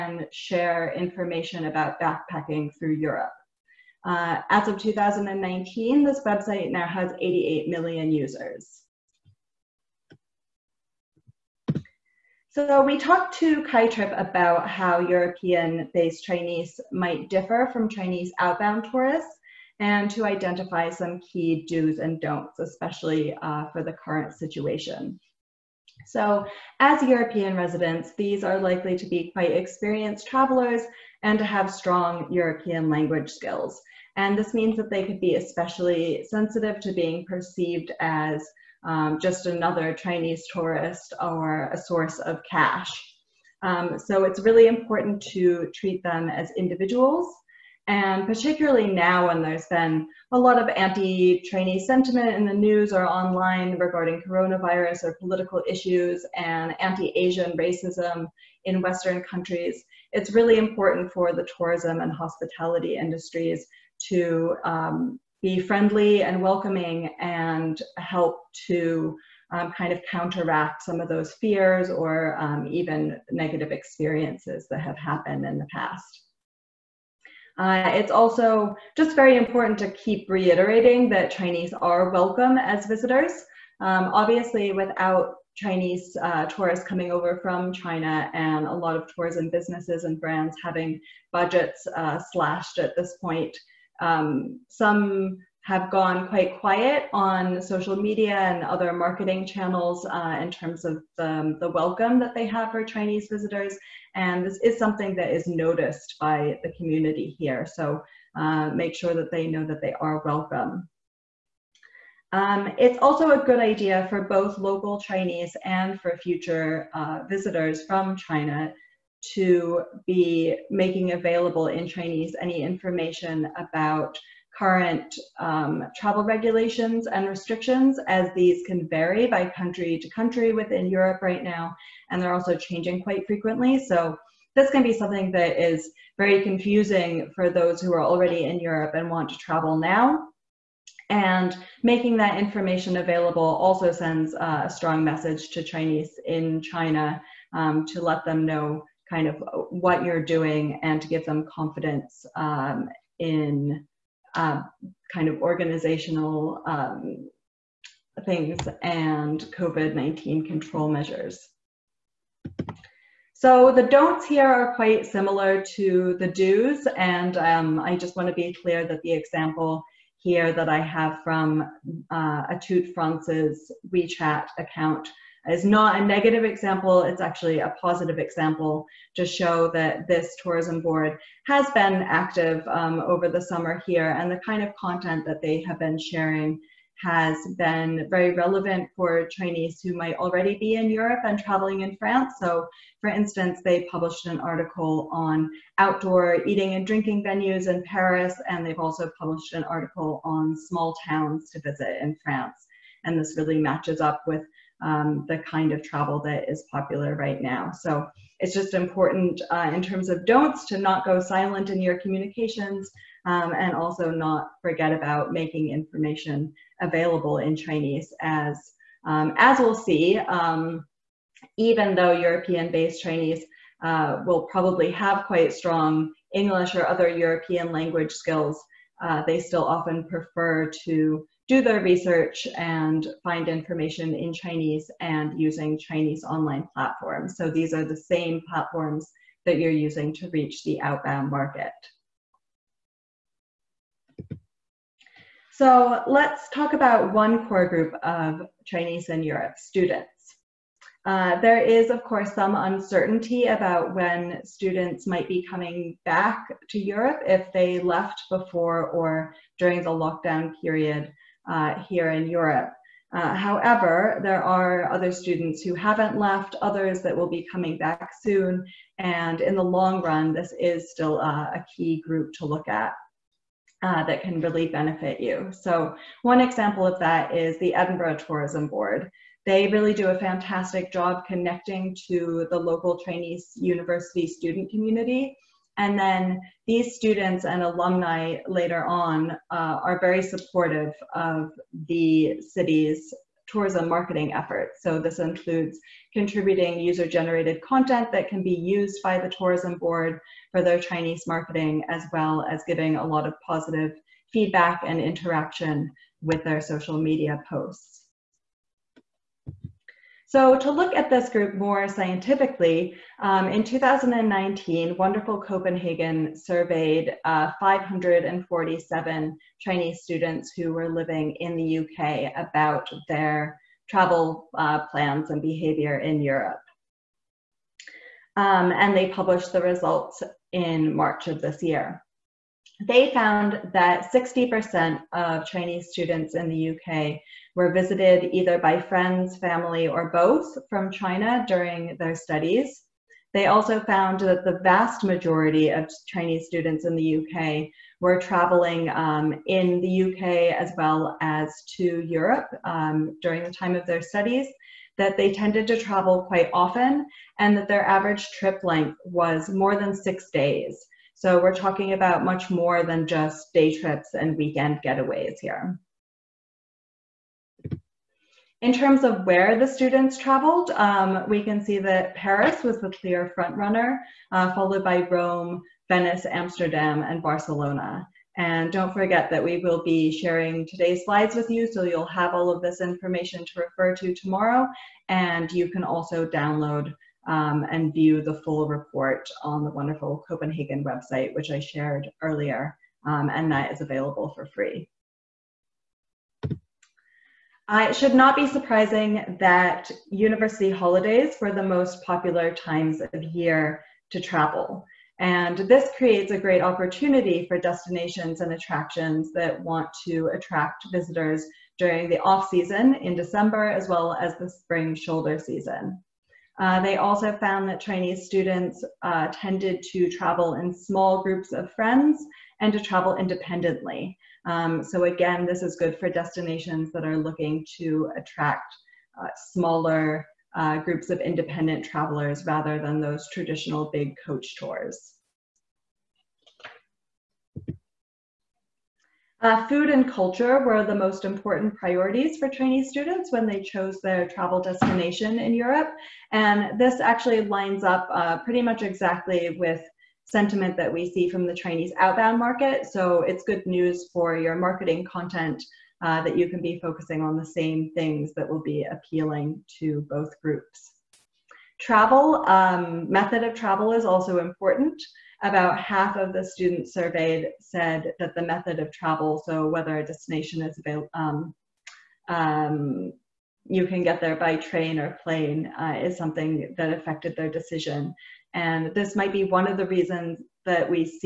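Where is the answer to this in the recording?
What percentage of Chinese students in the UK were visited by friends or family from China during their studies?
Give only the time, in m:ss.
5:34.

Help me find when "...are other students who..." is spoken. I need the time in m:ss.
4:24.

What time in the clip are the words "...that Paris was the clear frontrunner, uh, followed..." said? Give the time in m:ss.
6:11.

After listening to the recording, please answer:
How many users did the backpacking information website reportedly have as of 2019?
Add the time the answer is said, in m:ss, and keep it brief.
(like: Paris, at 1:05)
88 million, at 0:07.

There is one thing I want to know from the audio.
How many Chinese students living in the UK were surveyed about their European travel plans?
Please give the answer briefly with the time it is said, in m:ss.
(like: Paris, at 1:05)
547, at 5:17.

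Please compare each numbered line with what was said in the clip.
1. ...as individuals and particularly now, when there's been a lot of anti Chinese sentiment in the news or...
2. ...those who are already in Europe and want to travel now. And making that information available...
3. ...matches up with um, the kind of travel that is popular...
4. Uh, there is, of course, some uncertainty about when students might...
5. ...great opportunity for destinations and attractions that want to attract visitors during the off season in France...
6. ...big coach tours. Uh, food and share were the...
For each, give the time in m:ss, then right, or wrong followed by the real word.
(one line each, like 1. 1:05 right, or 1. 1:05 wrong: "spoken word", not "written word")
1. 0:46 right
2. 2:17 right
3. 3:23 right
4. 4:11 right
5. 6:46 wrong: "December", not "France"
6. 7:13 wrong: "culture", not "share".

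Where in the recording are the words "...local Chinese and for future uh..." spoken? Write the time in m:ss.
1:54.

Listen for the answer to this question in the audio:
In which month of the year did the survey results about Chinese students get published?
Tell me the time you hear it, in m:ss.
5:30.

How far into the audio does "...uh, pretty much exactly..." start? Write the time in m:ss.
7:28.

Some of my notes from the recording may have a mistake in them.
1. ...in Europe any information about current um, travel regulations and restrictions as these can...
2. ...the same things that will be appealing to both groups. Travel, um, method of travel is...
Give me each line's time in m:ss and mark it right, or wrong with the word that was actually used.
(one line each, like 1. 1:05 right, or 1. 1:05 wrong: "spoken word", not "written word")
1. 2:01 wrong: "Chinese", not "Europe"
2. 7:37 right.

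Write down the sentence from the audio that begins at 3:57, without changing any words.
So these are the same platforms that you're using to reach the outbound market.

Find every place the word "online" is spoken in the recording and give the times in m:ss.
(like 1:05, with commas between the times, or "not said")
0:53, 3:56.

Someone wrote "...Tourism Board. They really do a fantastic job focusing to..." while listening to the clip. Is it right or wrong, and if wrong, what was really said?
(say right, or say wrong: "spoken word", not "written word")
wrong: "connecting", not "focusing".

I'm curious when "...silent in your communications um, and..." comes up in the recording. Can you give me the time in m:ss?
3:31.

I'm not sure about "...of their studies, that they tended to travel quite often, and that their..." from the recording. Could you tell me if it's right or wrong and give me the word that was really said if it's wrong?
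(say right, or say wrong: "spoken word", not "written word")
right.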